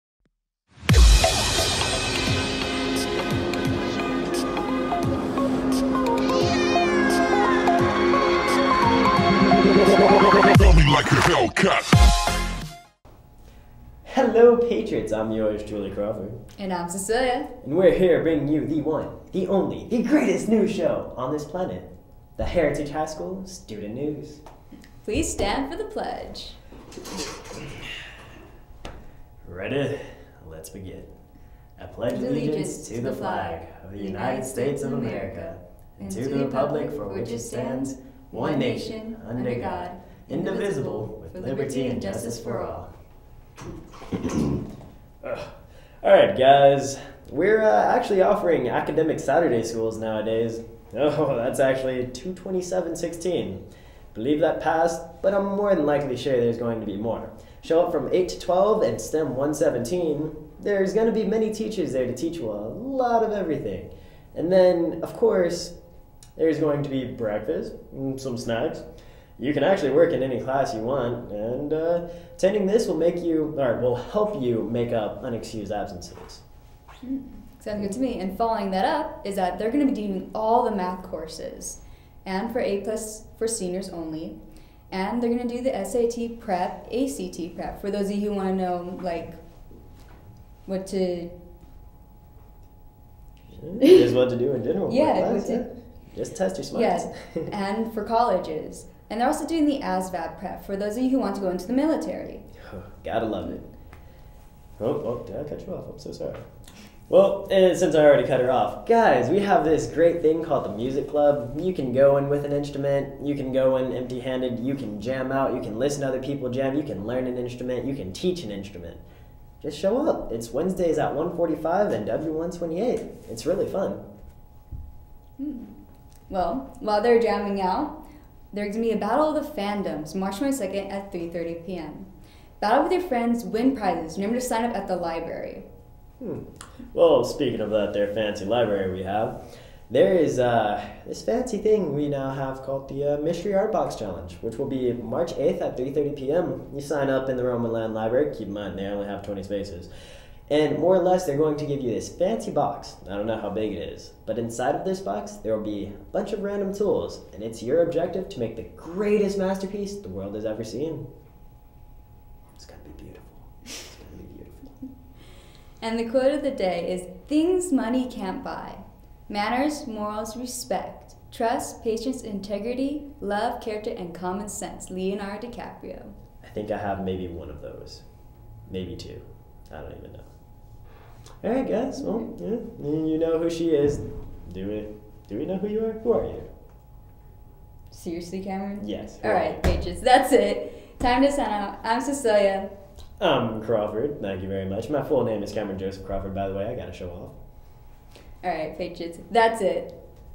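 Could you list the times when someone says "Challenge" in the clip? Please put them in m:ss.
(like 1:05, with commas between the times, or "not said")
2:23.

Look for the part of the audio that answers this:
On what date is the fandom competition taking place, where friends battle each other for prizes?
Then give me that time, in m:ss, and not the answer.
2:10.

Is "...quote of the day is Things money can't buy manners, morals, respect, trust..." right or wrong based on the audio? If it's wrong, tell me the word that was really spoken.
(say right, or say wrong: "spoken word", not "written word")
right.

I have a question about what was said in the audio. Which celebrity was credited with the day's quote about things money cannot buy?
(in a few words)
Leonardo DiCaprio.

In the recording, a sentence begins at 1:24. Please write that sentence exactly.
And they're going to do the SAT prep, ACT prep for those of you who want to know like what to.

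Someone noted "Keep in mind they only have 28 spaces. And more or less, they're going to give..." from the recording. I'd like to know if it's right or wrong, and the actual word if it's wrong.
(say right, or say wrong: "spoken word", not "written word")
wrong: "20", not "28".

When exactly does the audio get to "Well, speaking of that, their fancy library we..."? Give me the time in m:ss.
2:16.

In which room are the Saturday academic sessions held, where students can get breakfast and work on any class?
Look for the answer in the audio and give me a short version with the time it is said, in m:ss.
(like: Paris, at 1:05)
STEM 117, at 0:58.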